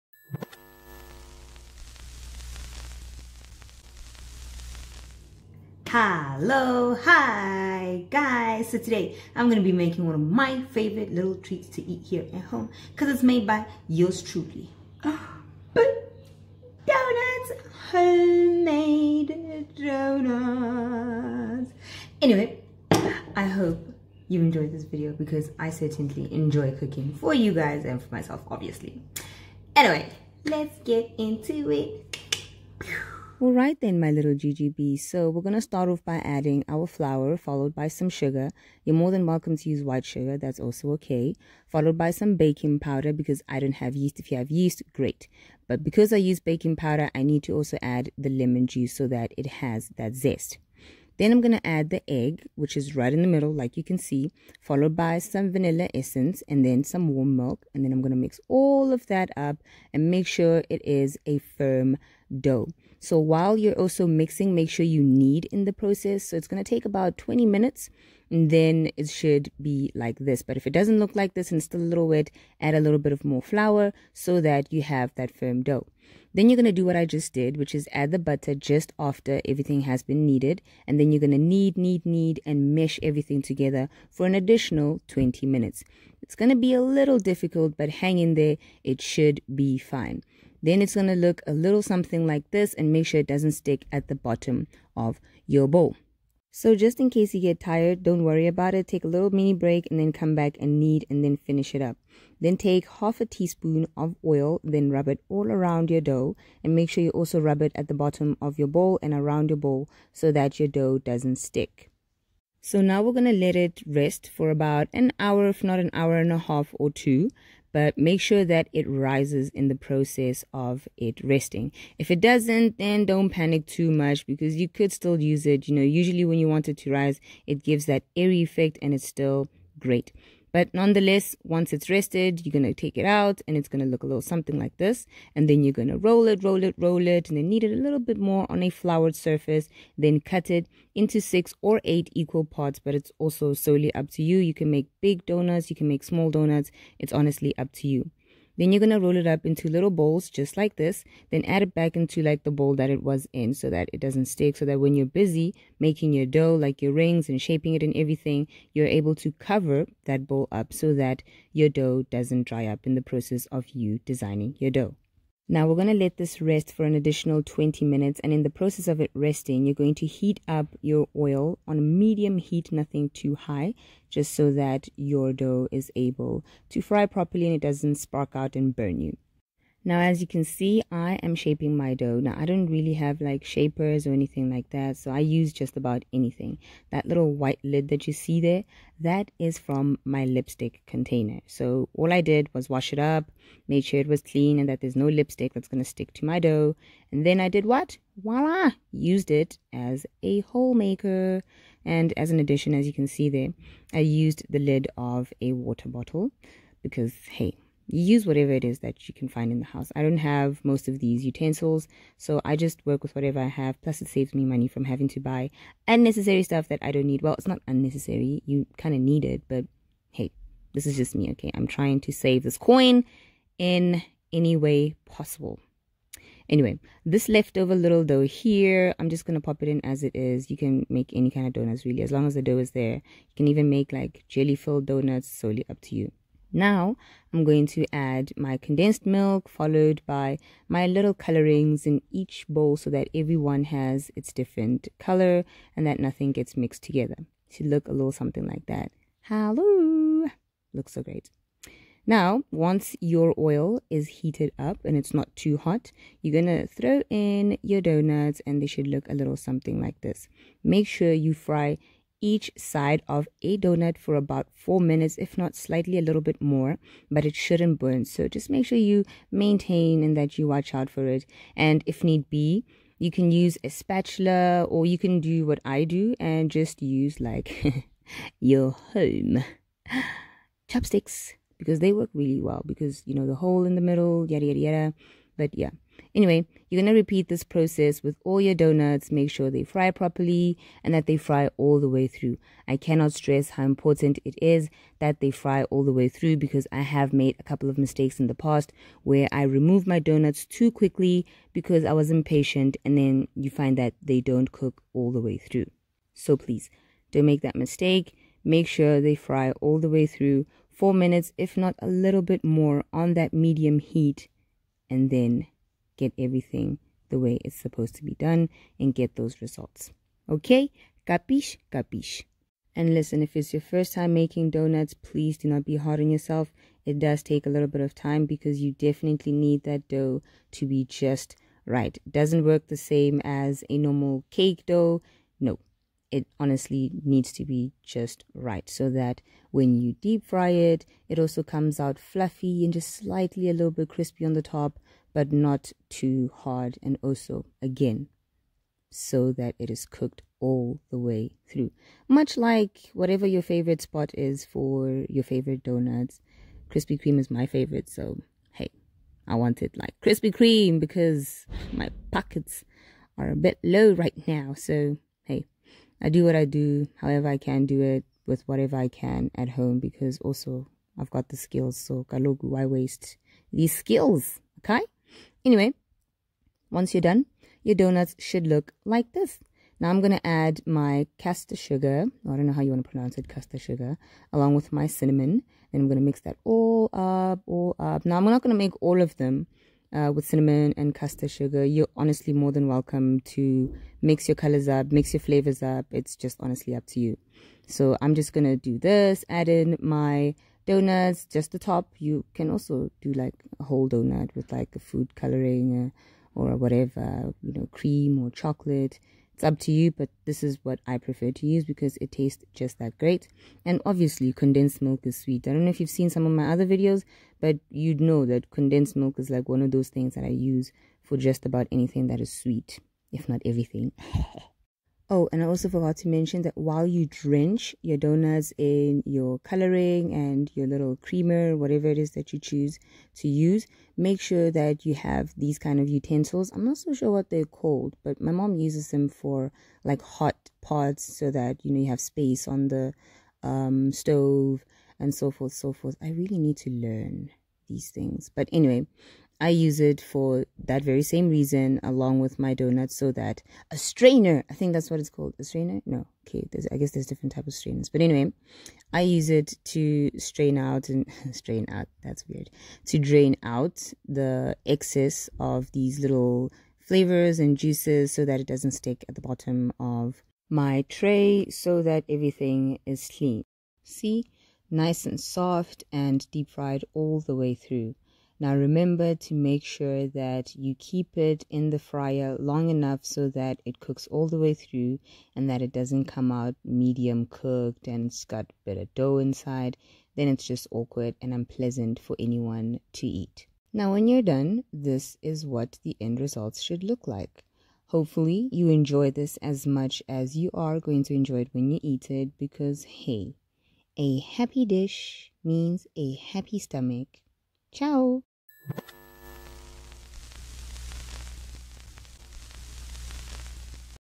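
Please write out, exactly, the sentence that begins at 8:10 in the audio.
Then it's just awkward and unpleasant for anyone to eat.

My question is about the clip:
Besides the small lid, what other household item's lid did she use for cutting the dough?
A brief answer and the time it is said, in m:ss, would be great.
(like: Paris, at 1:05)
water bottle, at 3:25.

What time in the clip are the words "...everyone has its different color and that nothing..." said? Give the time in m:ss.
4:03.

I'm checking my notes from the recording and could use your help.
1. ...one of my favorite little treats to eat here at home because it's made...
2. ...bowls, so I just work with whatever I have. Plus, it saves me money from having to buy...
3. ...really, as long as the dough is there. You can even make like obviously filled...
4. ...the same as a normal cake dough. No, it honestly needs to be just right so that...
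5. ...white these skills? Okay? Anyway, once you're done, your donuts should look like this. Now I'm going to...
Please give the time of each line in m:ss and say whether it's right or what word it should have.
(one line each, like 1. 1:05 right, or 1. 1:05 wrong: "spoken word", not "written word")
1. 0:10 right
2. 3:31 wrong: "utensils", not "bowls"
3. 3:51 wrong: "jelly", not "obviously"
4. 5:32 right
5. 6:12 wrong: "waste", not "white".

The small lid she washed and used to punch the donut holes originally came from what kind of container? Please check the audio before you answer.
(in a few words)
lipstick container.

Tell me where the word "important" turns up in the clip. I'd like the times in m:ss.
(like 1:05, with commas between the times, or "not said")
4:53.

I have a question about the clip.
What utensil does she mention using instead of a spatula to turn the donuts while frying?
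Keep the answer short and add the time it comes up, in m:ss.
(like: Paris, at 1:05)
chopsticks, at 4:40.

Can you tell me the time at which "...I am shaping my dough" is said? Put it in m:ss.
3:00.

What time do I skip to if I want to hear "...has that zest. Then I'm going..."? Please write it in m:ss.
0:49.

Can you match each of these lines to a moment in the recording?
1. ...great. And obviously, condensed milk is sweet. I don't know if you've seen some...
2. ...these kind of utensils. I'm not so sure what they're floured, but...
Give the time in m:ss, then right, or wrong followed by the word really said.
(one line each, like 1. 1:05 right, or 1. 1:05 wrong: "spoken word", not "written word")
1. 6:52 right
2. 7:15 wrong: "called", not "floured".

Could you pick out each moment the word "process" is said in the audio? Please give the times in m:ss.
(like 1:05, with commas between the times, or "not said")
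1:05, 1:59, 2:43, 2:48, 4:47.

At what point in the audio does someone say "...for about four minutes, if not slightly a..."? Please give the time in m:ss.
4:23.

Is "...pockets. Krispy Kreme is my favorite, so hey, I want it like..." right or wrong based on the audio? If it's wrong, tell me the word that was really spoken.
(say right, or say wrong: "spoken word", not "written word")
wrong: "donuts", not "pockets".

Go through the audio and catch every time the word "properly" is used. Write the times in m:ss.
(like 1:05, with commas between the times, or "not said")
2:57, 4:49.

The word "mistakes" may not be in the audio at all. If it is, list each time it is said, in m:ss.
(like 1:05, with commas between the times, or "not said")
4:57, 5:07.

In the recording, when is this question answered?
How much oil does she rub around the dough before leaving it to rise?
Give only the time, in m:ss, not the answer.
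1:42.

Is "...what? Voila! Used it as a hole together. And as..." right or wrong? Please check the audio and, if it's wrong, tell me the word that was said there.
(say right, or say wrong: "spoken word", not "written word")
wrong: "maker", not "together".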